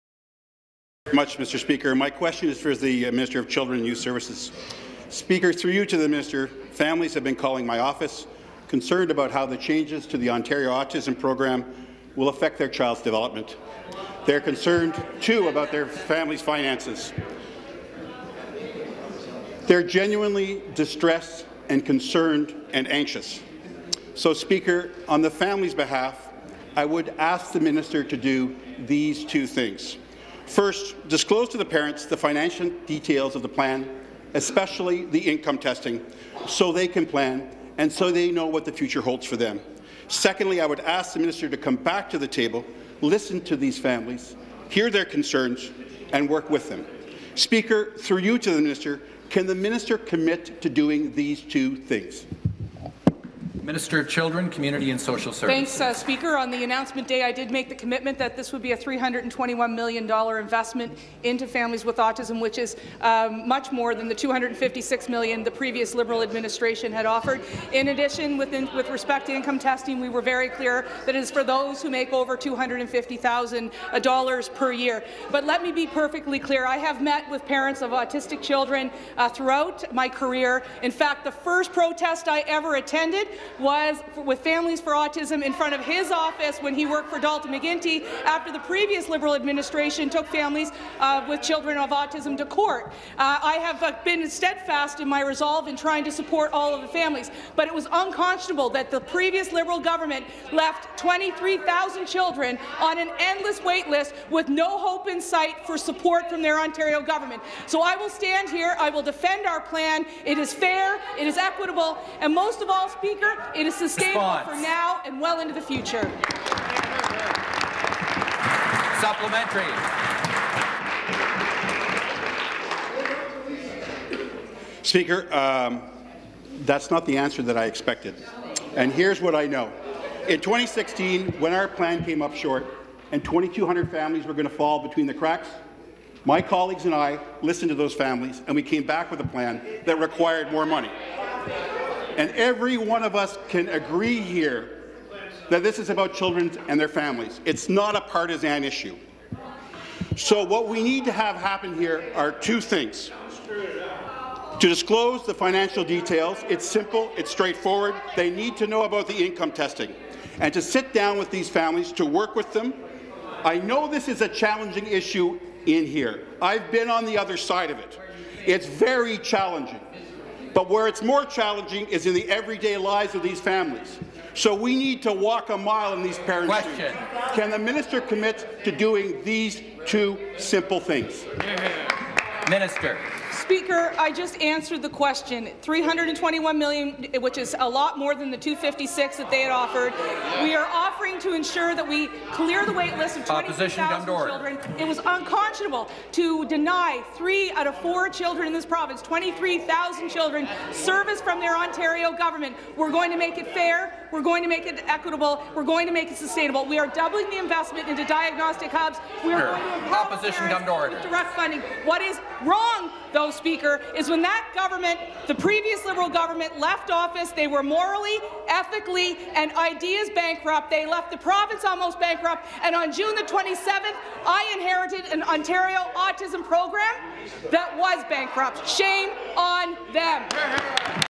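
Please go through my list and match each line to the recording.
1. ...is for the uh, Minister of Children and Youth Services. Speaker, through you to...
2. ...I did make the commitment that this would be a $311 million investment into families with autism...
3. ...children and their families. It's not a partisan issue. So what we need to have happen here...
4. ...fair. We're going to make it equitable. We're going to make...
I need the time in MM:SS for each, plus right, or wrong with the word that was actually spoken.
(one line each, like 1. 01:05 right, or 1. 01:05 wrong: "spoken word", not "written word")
1. 00:02 right
2. 00:57 wrong: "321", not "311"
3. 02:26 right
4. 03:23 right.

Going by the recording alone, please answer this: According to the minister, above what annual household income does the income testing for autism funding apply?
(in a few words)
$250,000.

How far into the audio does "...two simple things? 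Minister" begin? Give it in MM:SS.
02:59.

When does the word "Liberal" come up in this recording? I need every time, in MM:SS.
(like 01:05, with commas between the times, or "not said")
01:05, 01:29, 01:39, 03:35.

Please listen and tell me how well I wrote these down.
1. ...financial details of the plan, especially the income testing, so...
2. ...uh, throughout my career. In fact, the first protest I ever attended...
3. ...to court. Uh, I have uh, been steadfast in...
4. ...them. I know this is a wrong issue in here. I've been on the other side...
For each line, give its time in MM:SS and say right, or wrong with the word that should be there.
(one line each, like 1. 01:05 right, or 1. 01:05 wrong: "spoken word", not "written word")
1. 00:32 right
2. 01:19 right
3. 01:32 right
4. 02:42 wrong: "challenging", not "wrong".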